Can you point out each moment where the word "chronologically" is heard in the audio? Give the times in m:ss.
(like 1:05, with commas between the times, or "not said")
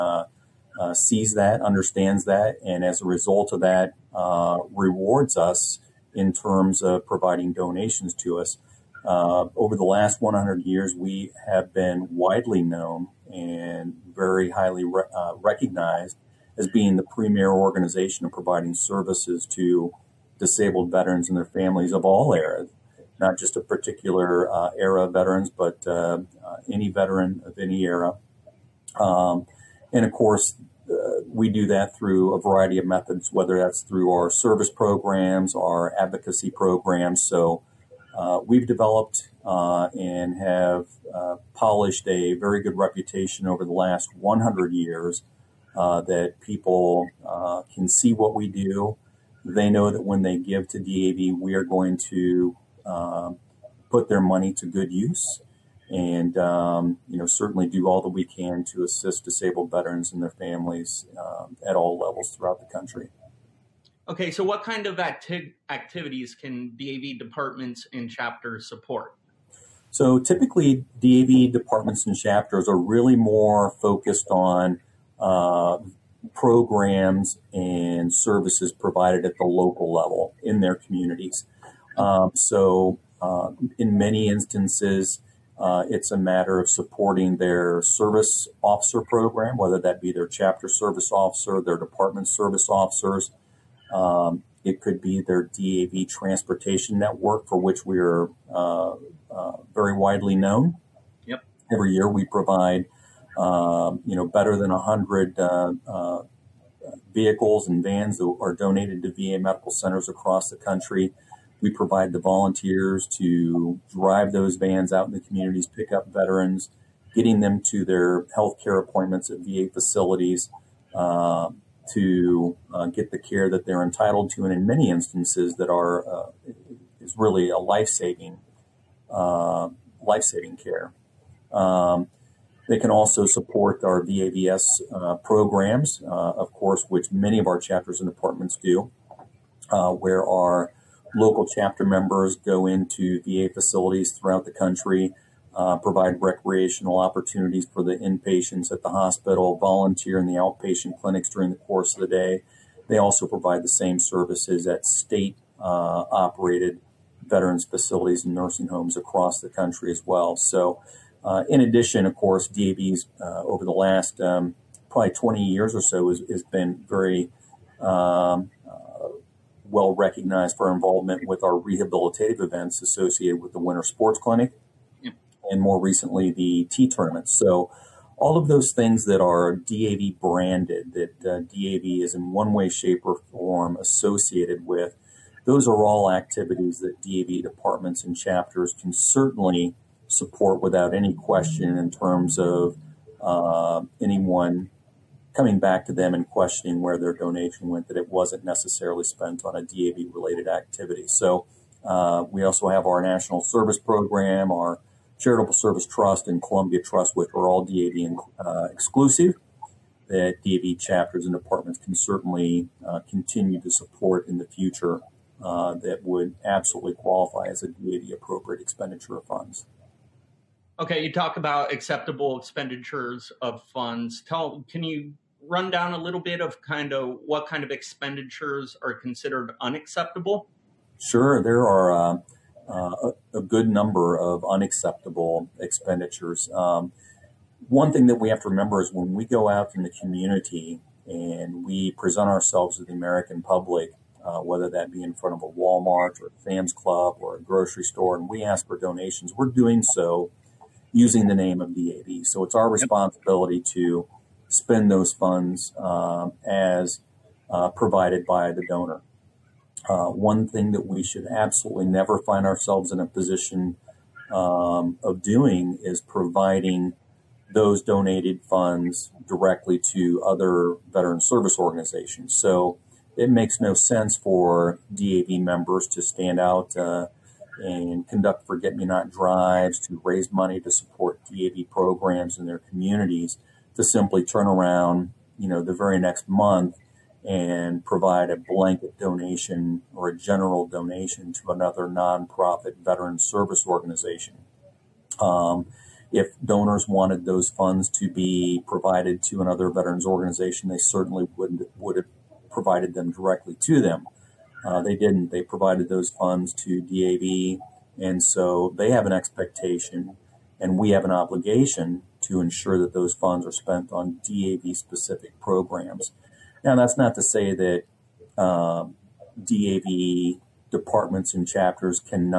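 not said.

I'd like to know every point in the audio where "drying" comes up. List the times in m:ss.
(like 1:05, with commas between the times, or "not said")
not said.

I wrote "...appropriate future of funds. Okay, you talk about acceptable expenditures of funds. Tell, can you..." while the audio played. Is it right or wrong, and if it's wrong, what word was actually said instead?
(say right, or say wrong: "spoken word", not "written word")
wrong: "expenditure", not "future".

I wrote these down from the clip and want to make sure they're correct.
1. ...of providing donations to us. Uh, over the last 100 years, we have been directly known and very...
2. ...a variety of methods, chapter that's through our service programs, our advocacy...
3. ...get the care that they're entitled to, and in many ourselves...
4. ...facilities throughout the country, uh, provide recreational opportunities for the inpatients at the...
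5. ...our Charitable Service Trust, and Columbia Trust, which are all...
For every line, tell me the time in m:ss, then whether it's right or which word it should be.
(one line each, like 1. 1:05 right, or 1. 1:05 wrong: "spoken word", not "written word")
1. 0:06 wrong: "widely", not "directly"
2. 0:32 wrong: "whether", not "chapter"
3. 2:02 wrong: "instances", not "ourselves"
4. 2:23 right
5. 3:24 right.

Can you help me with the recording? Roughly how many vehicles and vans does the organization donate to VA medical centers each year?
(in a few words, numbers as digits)
more than 100.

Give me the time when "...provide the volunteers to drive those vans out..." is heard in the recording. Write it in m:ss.
1:51.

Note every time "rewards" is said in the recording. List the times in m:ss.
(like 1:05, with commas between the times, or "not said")
0:04.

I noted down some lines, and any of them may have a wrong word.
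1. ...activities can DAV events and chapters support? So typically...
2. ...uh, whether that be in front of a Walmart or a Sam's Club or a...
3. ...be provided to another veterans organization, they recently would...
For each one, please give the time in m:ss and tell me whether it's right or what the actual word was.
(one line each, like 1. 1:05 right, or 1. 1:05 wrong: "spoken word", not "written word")
1. 1:05 wrong: "departments", not "events"
2. 4:04 right
3. 4:58 wrong: "certainly", not "recently".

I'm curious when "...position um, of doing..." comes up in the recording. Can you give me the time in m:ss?
4:23.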